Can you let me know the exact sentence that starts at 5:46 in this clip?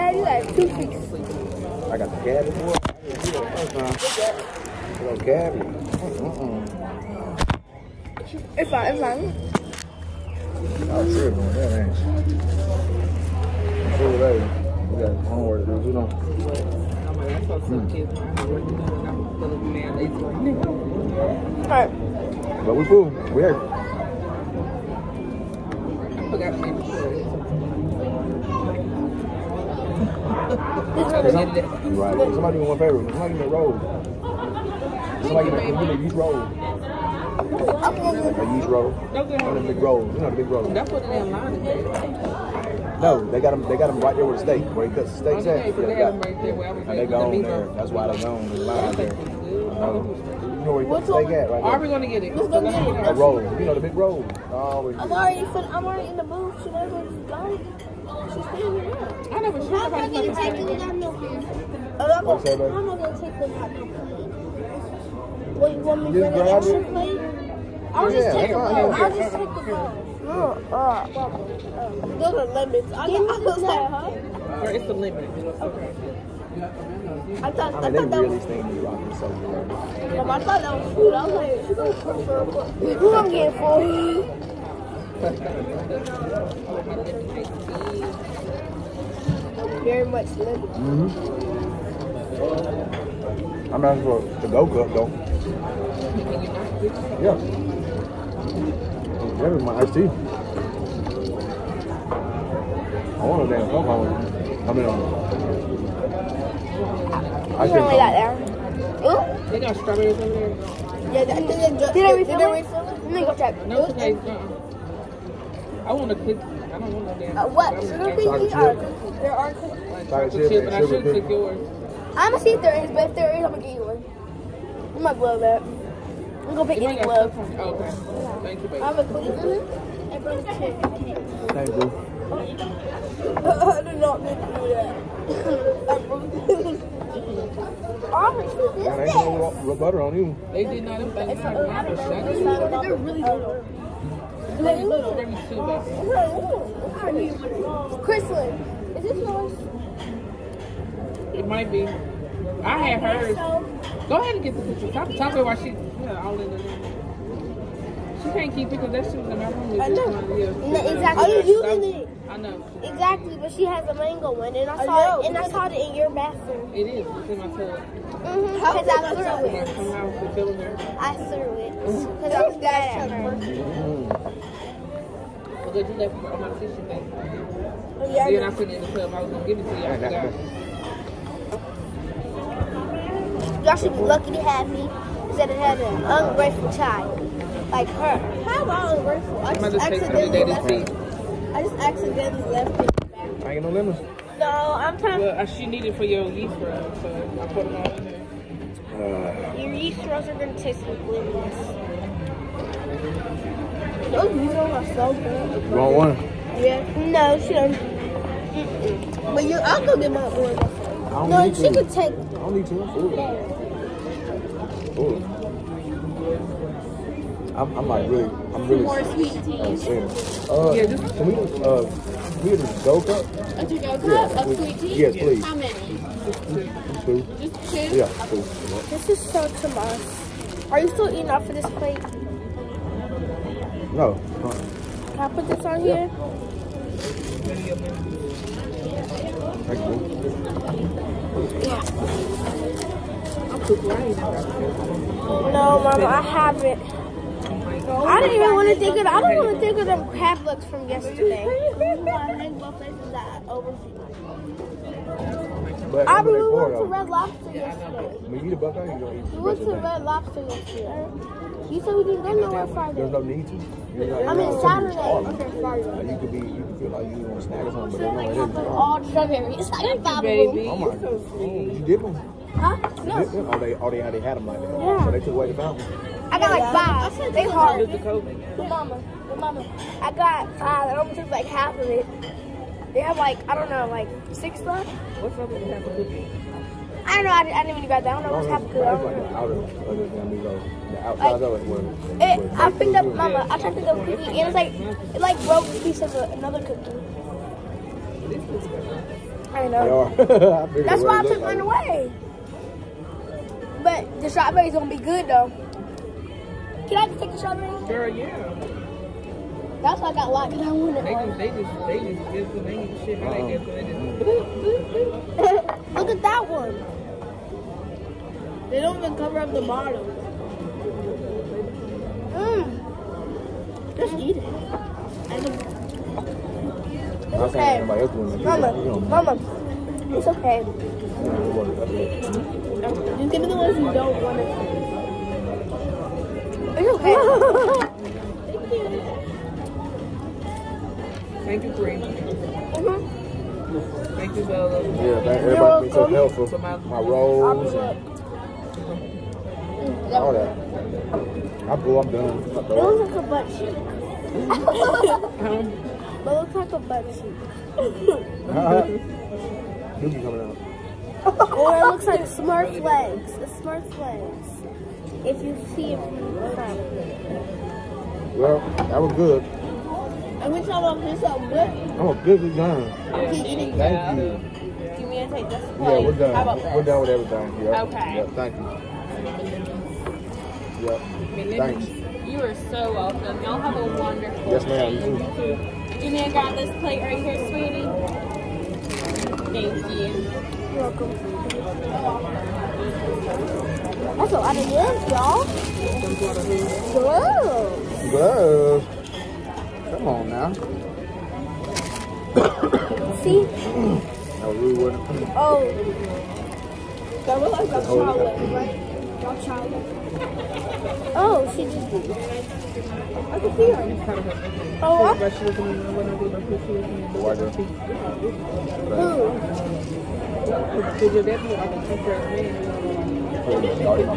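my, my rolls and all that.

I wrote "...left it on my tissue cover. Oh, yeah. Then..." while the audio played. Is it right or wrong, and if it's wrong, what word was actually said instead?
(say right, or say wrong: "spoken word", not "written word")
wrong: "paper", not "cover".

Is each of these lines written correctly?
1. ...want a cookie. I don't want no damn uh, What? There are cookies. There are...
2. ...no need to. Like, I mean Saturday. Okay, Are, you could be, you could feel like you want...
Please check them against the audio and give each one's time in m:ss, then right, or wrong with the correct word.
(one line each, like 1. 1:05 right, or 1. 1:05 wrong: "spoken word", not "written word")
1. 1:55 right
2. 4:23 wrong: "Like", not "Are".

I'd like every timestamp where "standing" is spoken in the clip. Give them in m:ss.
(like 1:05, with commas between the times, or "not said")
0:58.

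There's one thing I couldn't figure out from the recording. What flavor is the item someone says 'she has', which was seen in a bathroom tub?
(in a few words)
mango.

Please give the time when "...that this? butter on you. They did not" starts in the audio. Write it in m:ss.
2:18.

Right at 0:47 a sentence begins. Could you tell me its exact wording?
That's why they go on the line there.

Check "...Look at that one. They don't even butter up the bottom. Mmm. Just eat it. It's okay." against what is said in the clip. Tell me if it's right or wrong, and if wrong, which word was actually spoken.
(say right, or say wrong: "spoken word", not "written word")
wrong: "cover", not "butter".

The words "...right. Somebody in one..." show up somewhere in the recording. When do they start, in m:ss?
0:31.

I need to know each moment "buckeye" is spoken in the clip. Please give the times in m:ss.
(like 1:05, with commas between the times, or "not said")
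4:18.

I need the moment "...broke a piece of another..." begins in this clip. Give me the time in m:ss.
4:55.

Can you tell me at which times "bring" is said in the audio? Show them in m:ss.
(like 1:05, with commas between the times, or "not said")
1:06, 2:10.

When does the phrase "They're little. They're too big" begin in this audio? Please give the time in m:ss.
2:24.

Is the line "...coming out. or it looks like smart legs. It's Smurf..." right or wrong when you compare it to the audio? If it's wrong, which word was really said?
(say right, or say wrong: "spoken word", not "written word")
right.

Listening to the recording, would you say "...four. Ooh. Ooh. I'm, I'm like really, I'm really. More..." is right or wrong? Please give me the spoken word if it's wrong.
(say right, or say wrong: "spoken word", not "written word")
wrong: "two", not "four".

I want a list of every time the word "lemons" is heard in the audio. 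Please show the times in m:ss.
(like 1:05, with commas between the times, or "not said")
1:12, 3:13, 3:21.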